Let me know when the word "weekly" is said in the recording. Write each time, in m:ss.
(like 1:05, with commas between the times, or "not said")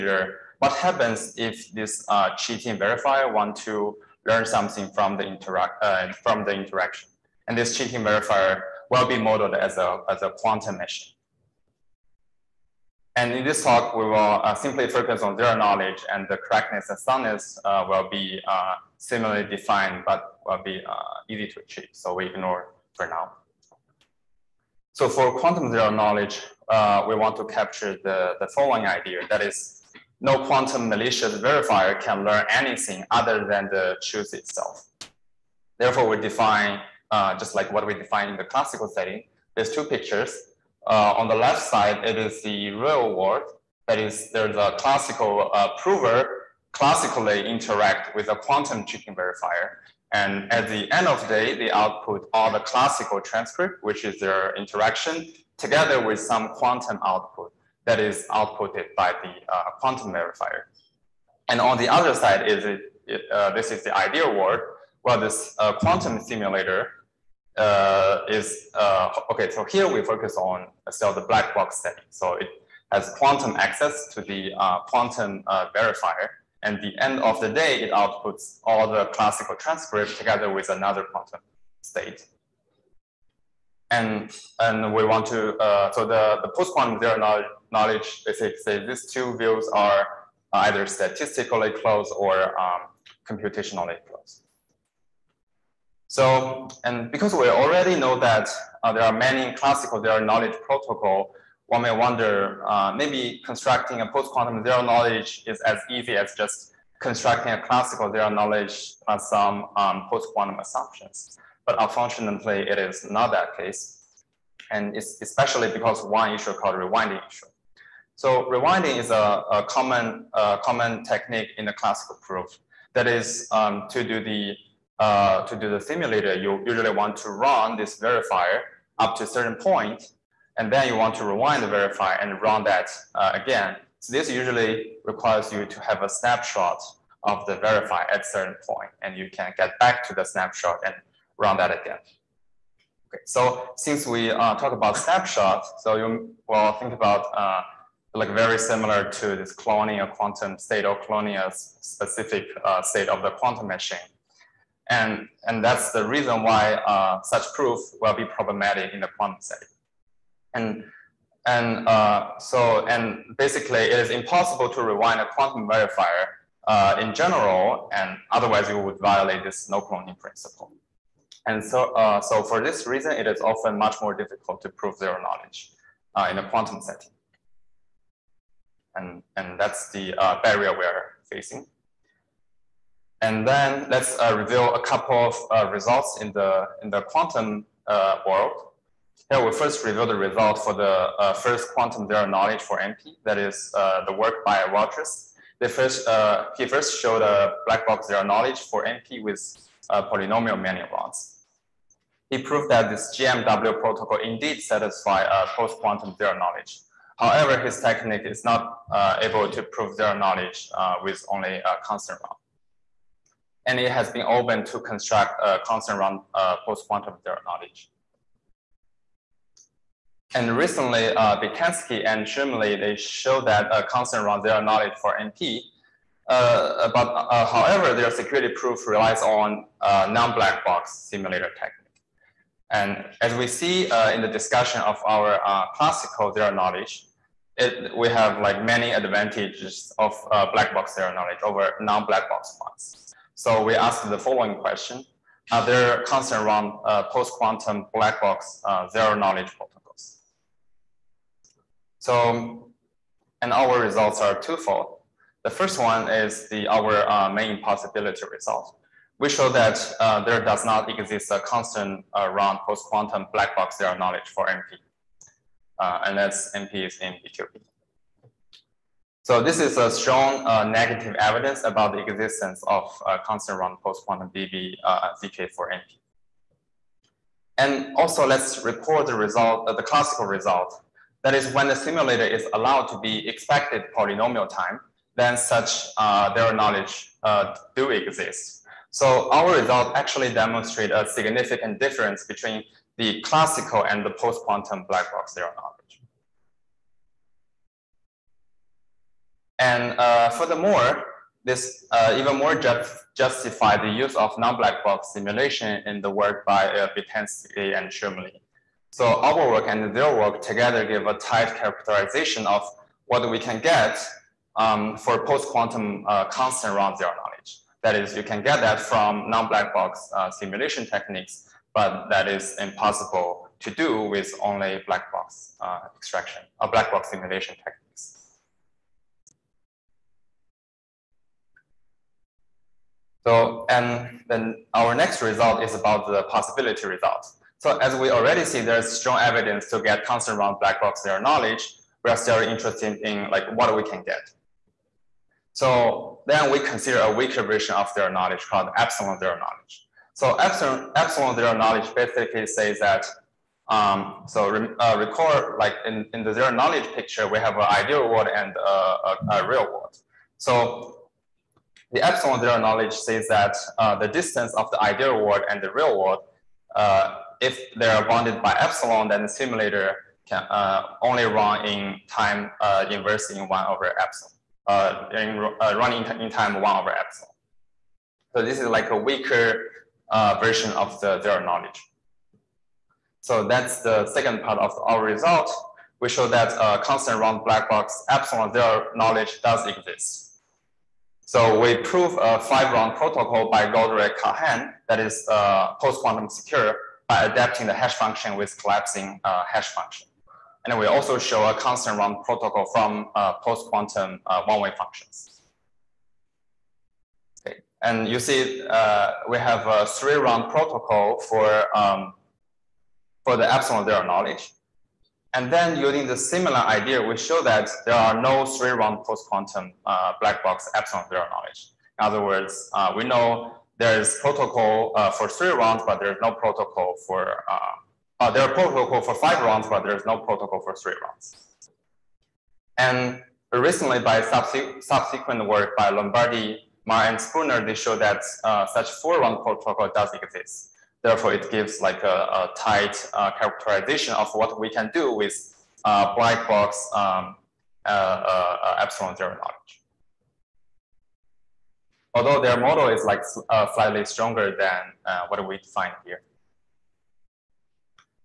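not said.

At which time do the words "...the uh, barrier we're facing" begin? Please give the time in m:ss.
2:59.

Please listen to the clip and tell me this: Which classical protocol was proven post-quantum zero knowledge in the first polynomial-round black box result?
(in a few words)
GMW protocol.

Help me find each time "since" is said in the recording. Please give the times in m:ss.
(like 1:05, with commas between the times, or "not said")
2:23.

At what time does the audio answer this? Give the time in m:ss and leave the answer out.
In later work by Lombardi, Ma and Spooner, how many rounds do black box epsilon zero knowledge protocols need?
7:19.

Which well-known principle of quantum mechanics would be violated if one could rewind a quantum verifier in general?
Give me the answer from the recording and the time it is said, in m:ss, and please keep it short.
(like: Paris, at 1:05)
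No cloning principle, at 2:49.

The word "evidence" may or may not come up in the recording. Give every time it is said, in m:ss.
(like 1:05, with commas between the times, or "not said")
4:31, 5:39.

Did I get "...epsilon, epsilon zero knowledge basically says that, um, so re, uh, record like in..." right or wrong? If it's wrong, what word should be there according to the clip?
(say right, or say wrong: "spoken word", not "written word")
right.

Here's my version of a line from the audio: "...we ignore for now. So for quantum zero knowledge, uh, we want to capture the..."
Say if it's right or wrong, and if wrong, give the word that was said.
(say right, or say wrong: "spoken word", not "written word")
right.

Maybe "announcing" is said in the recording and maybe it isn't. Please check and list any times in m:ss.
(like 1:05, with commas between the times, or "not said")
not said.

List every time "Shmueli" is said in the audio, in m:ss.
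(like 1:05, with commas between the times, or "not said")
3:42, 5:07.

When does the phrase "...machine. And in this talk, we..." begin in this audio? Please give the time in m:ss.
0:10.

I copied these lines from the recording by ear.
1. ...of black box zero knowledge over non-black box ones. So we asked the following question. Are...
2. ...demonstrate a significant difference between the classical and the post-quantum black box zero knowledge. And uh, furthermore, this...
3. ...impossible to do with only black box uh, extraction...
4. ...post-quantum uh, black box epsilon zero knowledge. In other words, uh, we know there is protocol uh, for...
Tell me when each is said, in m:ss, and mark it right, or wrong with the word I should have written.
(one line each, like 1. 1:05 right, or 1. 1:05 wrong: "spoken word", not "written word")
1. 3:59 right
2. 4:50 right
3. 5:22 right
4. 6:59 right.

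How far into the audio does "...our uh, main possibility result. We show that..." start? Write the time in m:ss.
4:16.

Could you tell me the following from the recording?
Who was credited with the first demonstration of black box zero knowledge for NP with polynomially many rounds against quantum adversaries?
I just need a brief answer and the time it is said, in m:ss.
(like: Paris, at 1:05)
Rogers, at 3:14.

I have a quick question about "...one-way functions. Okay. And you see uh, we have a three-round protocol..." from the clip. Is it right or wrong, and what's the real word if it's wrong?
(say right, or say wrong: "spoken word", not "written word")
right.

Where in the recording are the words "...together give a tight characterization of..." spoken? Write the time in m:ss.
5:10.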